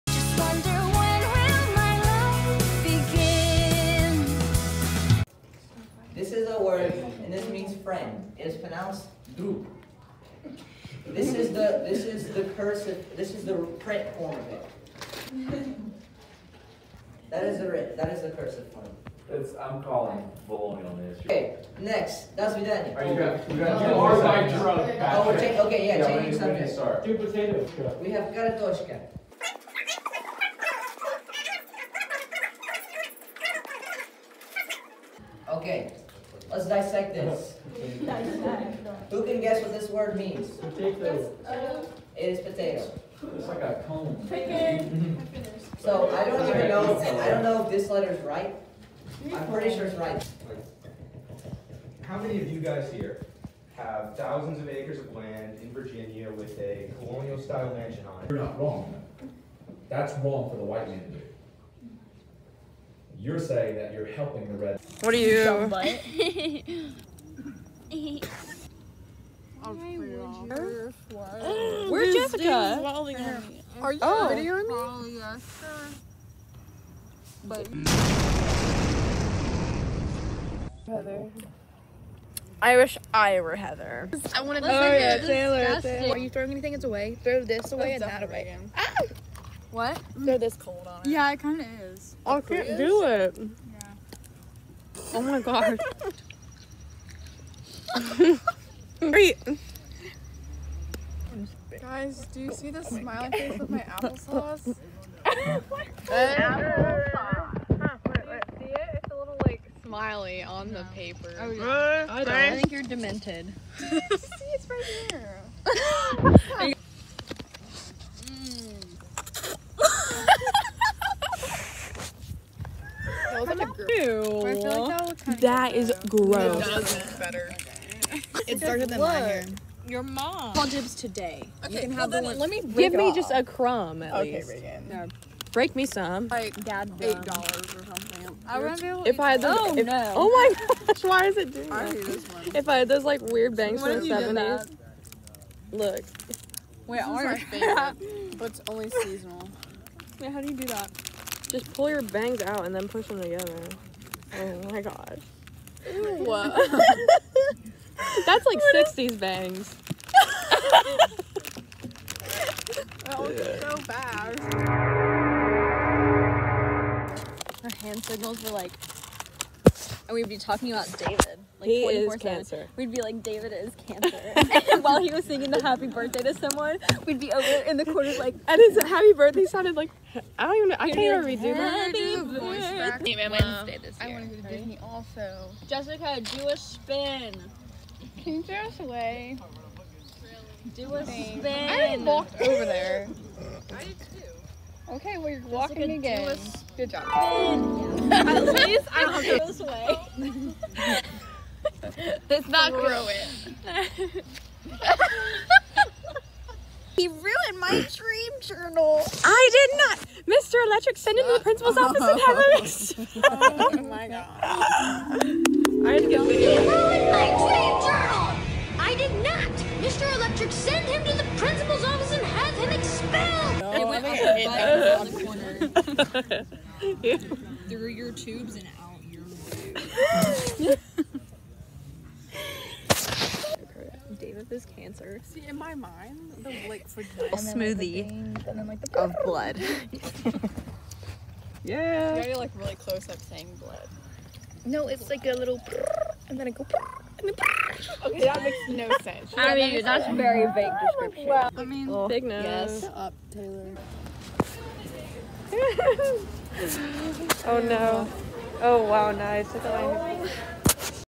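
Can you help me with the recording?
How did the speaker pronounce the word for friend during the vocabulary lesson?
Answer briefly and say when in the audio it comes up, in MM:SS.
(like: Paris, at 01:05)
drup, at 00:09.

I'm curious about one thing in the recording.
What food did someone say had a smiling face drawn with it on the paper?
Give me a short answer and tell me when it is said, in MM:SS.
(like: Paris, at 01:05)
applesauce, at 01:43.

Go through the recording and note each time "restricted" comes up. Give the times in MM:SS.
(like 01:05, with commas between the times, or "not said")
not said.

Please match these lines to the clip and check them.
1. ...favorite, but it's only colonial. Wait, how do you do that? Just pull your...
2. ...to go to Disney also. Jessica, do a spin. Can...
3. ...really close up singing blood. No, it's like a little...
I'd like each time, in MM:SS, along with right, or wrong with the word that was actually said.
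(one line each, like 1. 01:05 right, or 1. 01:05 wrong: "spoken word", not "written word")
1. 02:27 wrong: "seasonal", not "colonial"
2. 03:04 right
3. 04:02 wrong: "saying", not "singing".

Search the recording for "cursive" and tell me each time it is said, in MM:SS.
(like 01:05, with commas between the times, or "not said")
00:12, 00:18.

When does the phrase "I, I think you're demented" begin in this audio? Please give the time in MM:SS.
01:52.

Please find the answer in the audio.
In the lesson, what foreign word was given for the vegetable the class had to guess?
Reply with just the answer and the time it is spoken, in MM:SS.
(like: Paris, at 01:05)
karatoshka, at 00:28.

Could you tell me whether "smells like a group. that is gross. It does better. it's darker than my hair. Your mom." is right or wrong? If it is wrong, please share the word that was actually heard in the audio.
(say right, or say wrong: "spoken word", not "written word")
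right.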